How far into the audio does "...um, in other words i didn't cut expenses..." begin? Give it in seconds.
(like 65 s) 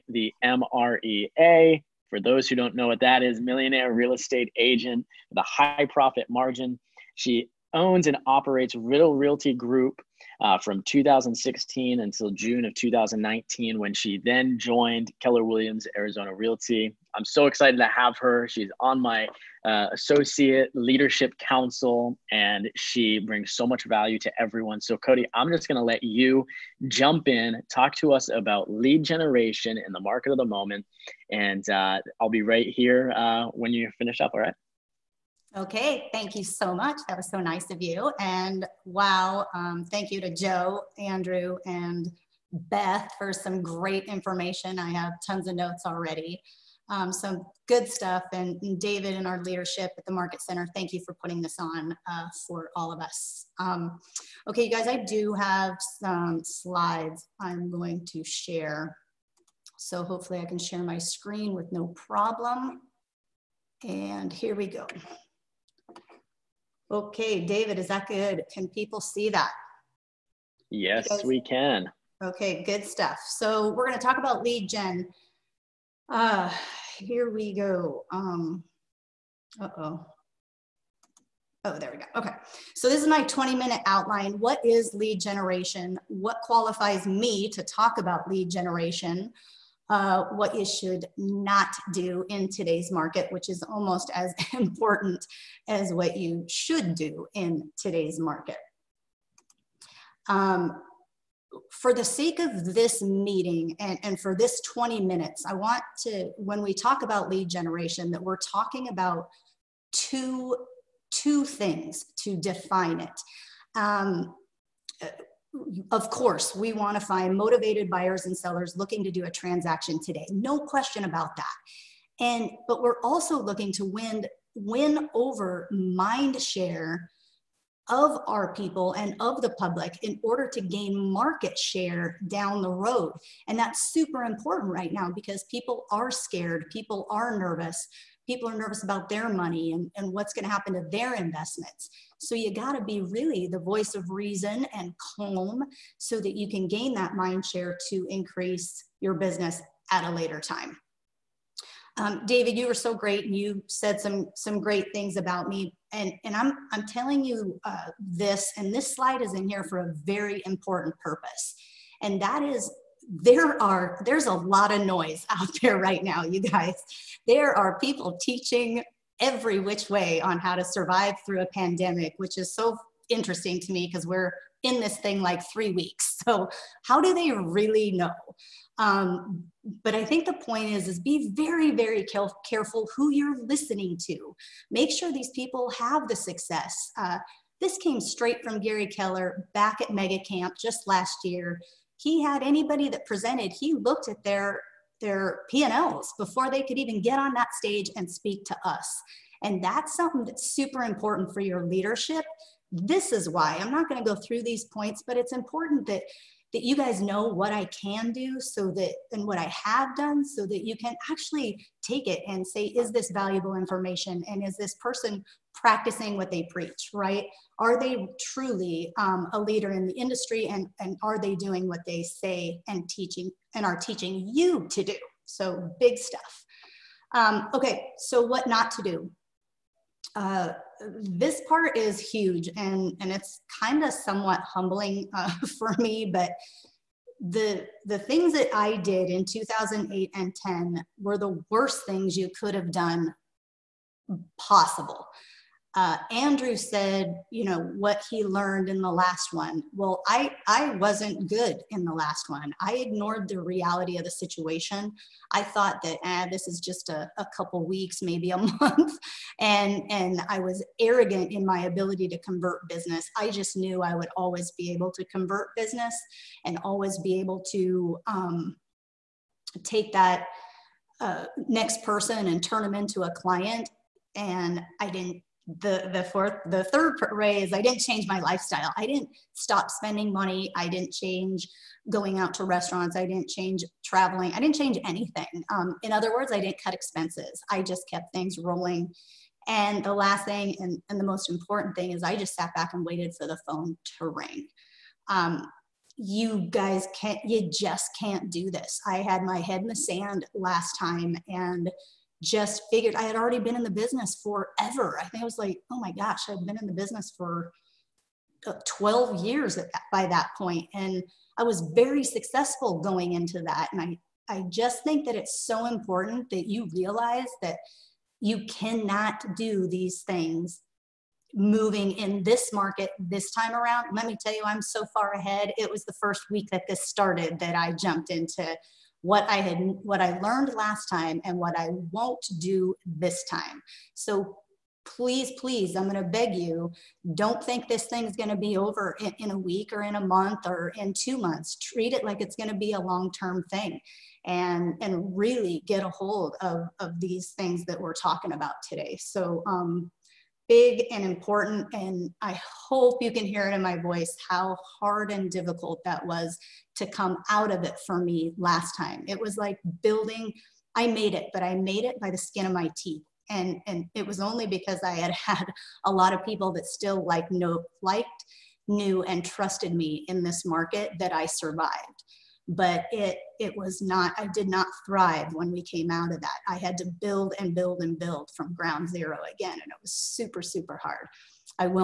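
285 s.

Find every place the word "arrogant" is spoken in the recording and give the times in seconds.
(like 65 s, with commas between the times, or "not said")
260 s.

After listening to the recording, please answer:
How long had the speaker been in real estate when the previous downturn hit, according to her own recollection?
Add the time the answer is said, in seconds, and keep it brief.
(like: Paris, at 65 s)
12 years, at 308 s.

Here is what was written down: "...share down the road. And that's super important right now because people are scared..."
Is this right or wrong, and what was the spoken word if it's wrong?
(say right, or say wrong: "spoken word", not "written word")
right.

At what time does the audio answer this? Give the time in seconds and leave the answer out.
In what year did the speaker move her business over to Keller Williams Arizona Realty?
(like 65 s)
12 s.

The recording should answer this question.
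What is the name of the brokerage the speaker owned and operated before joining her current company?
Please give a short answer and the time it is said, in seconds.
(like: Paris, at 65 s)
Riddle Realty Group, at 8 s.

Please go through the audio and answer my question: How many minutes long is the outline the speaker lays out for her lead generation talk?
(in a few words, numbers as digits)
20.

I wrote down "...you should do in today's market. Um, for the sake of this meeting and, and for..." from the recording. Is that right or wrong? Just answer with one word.
right.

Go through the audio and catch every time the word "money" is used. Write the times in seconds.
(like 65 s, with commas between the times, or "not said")
139 s, 280 s.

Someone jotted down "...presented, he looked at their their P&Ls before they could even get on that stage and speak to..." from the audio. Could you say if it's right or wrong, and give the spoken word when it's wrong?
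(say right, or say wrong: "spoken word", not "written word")
right.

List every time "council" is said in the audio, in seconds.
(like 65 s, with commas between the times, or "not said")
21 s.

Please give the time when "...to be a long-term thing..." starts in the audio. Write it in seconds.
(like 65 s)
342 s.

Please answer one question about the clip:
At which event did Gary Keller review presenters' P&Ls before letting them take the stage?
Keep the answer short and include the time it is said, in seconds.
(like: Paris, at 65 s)
Mega Camp, at 189 s.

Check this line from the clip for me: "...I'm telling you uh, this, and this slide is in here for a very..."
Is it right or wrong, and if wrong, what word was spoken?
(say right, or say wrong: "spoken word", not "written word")
right.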